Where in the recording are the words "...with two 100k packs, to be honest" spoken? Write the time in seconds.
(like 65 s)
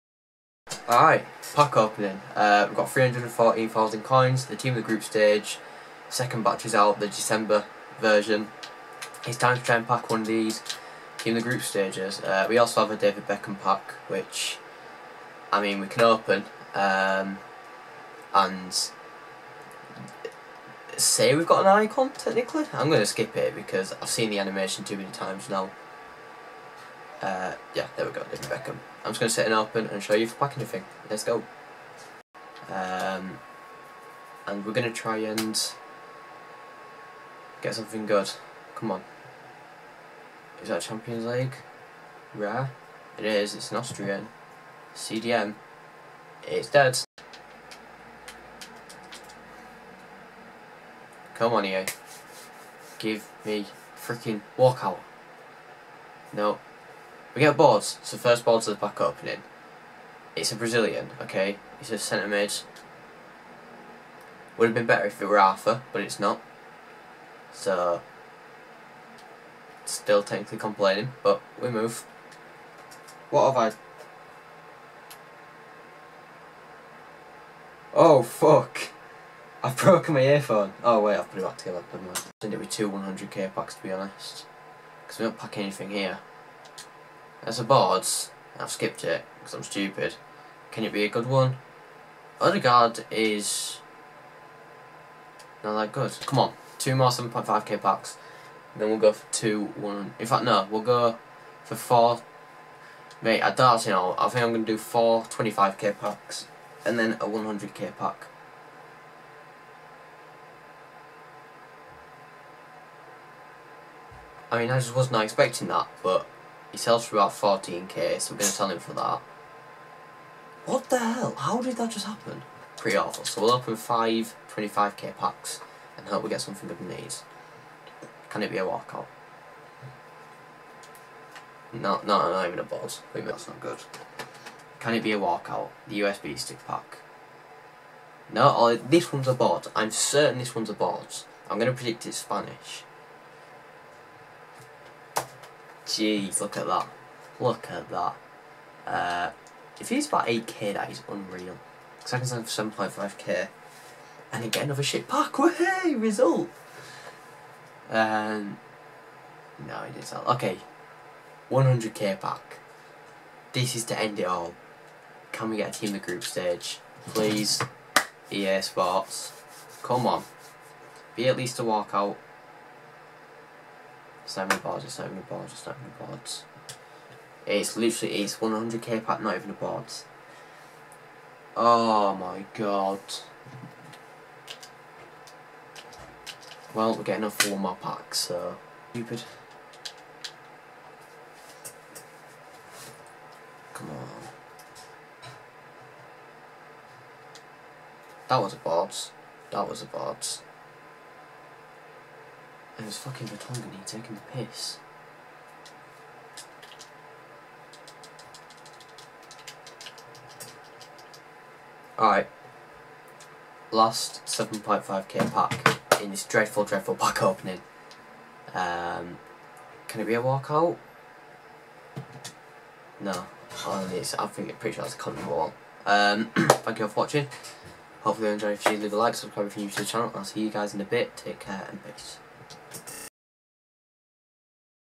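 82 s.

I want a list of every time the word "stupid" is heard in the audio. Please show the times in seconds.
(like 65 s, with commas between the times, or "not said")
89 s, 188 s.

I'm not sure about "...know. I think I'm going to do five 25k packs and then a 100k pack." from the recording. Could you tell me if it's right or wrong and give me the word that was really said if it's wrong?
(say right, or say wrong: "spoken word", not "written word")
wrong: "four", not "five".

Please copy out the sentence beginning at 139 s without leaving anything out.
I'm certain this one's a bot.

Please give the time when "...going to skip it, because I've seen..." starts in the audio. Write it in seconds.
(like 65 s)
22 s.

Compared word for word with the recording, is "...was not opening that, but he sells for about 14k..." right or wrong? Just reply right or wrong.
wrong.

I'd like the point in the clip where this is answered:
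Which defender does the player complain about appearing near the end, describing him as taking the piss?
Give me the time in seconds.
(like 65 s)
203 s.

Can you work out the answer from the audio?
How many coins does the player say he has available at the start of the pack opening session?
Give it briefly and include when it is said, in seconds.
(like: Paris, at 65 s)
314,000, at 2 s.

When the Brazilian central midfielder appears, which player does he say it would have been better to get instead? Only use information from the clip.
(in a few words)
Arthur.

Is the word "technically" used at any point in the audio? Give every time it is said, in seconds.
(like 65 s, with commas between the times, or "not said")
22 s, 70 s.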